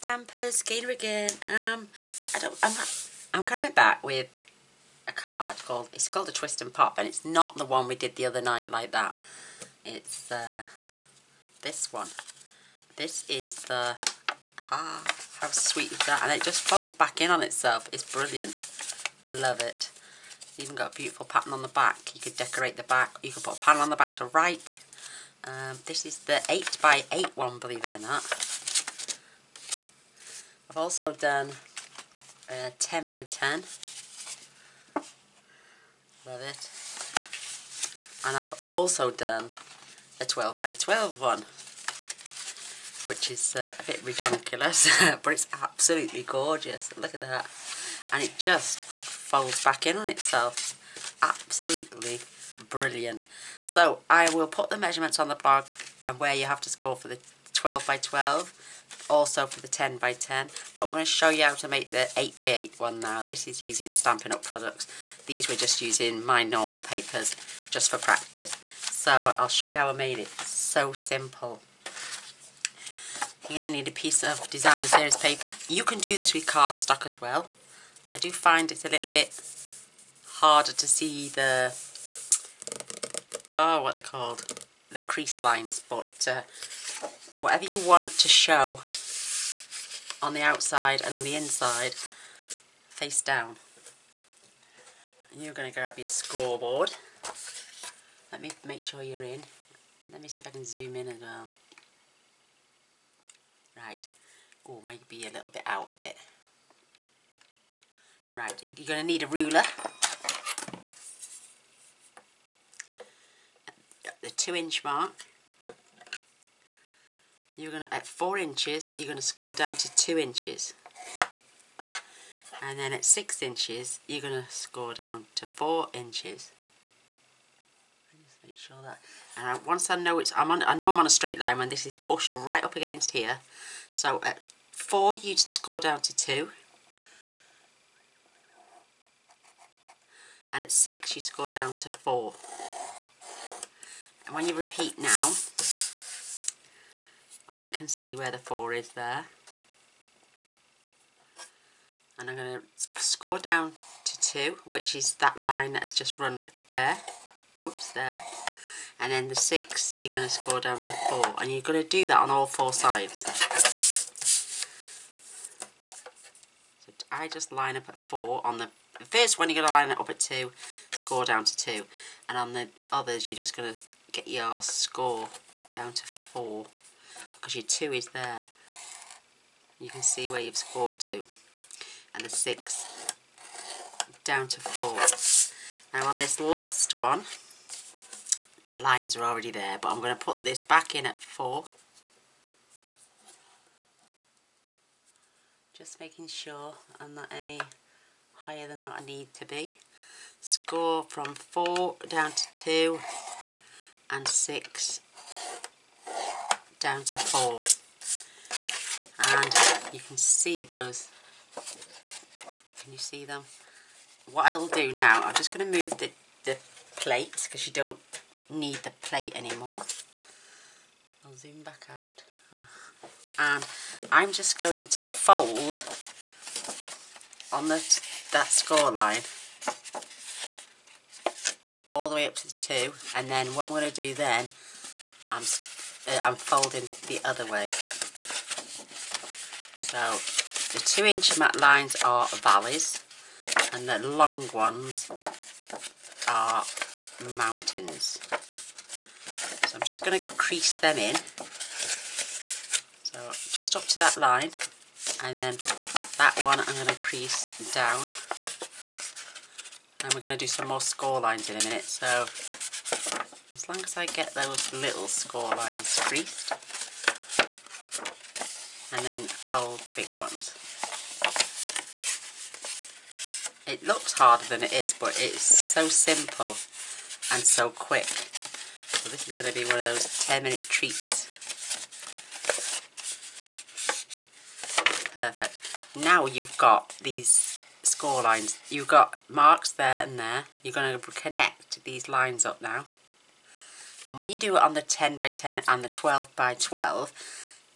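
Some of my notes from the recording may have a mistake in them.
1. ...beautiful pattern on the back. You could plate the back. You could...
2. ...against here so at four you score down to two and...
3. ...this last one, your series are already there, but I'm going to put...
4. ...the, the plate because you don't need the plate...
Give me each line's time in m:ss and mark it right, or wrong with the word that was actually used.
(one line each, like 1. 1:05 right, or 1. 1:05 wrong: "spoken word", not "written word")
1. 0:20 wrong: "decorate", not "plate"
2. 2:12 right
3. 3:06 wrong: "lines", not "series"
4. 3:35 right.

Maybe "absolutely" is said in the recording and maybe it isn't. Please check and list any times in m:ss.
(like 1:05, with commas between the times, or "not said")
0:45, 0:51.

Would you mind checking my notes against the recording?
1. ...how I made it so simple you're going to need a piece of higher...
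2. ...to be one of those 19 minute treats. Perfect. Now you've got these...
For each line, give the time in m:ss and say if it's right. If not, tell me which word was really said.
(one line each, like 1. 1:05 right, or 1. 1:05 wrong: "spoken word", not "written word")
1. 1:09 wrong: "designer", not "higher"
2. 4:39 wrong: "10", not "19".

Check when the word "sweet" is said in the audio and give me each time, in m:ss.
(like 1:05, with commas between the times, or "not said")
0:15.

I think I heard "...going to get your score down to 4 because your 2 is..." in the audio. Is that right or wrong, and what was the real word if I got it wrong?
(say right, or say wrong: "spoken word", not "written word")
right.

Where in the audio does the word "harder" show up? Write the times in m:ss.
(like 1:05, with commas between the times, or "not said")
1:20, 4:34.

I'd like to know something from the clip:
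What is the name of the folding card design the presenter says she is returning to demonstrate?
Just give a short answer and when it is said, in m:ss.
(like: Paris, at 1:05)
Twist and Pop, at 0:06.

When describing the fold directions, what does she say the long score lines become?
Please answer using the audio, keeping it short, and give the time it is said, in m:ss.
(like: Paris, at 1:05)
mountains, at 4:07.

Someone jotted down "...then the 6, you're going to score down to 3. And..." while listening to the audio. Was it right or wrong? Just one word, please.
wrong.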